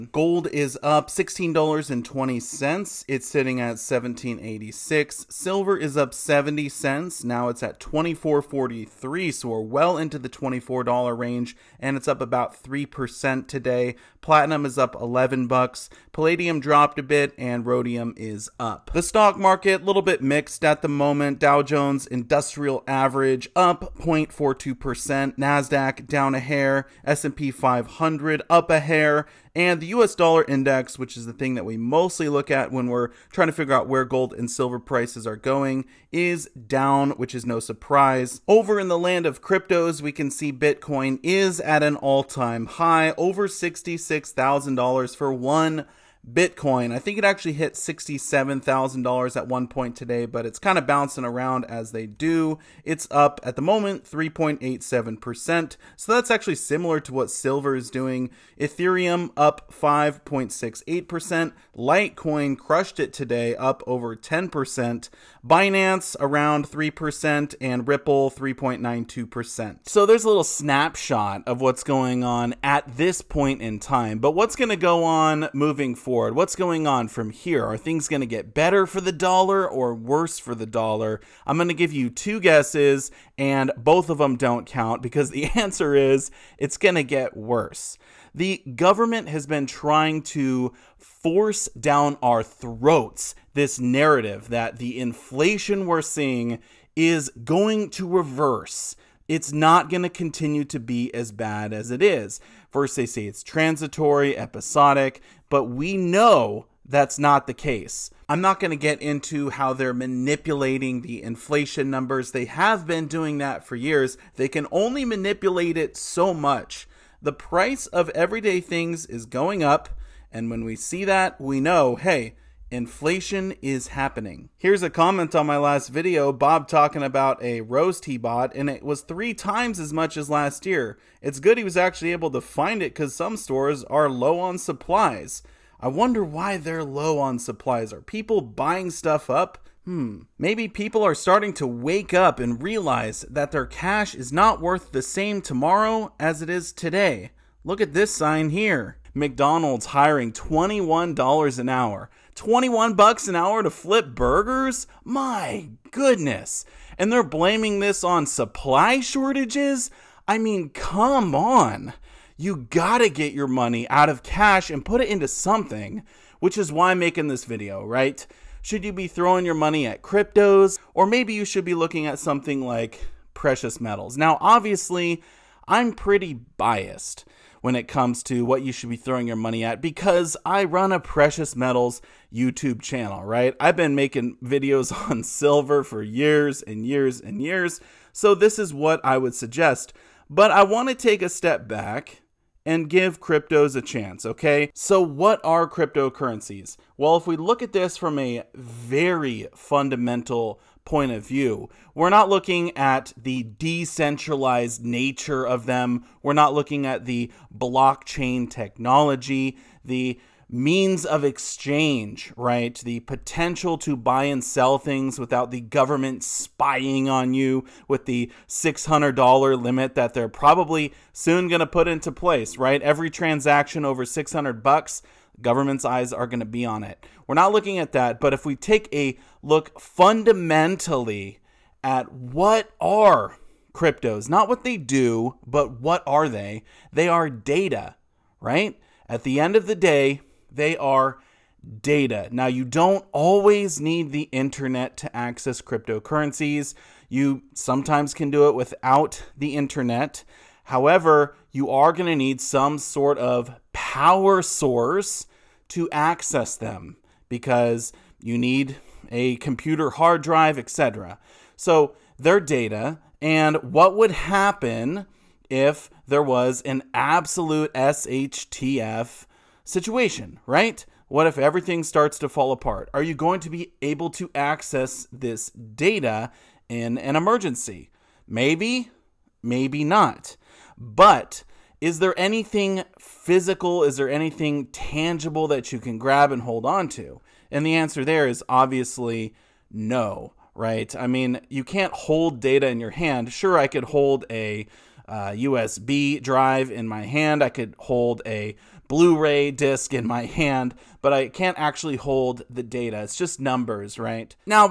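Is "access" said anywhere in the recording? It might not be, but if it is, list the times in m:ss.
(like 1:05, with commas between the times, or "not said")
4:05, 4:15, 4:34.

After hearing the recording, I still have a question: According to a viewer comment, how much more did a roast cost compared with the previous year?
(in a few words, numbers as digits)
three times.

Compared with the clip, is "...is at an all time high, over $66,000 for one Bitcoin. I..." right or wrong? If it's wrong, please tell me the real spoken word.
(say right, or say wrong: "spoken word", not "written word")
right.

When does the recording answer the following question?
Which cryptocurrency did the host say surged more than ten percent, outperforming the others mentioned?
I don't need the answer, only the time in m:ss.
1:01.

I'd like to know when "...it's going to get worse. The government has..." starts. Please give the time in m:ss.
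1:26.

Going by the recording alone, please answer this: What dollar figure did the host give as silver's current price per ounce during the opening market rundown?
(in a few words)
24.43.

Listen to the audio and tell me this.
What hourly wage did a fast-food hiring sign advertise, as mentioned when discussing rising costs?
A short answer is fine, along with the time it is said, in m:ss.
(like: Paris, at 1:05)
$21, at 2:30.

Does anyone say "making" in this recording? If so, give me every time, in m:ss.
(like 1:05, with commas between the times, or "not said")
2:46, 3:03.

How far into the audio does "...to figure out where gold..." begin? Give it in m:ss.
0:33.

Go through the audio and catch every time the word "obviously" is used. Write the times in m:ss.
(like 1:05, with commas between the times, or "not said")
2:54, 4:48.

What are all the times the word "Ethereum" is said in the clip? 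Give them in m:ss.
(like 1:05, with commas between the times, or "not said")
0:58.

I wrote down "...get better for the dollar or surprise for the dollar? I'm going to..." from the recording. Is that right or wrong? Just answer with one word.
wrong.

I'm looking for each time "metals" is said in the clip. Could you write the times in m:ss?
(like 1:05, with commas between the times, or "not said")
2:53, 3:01.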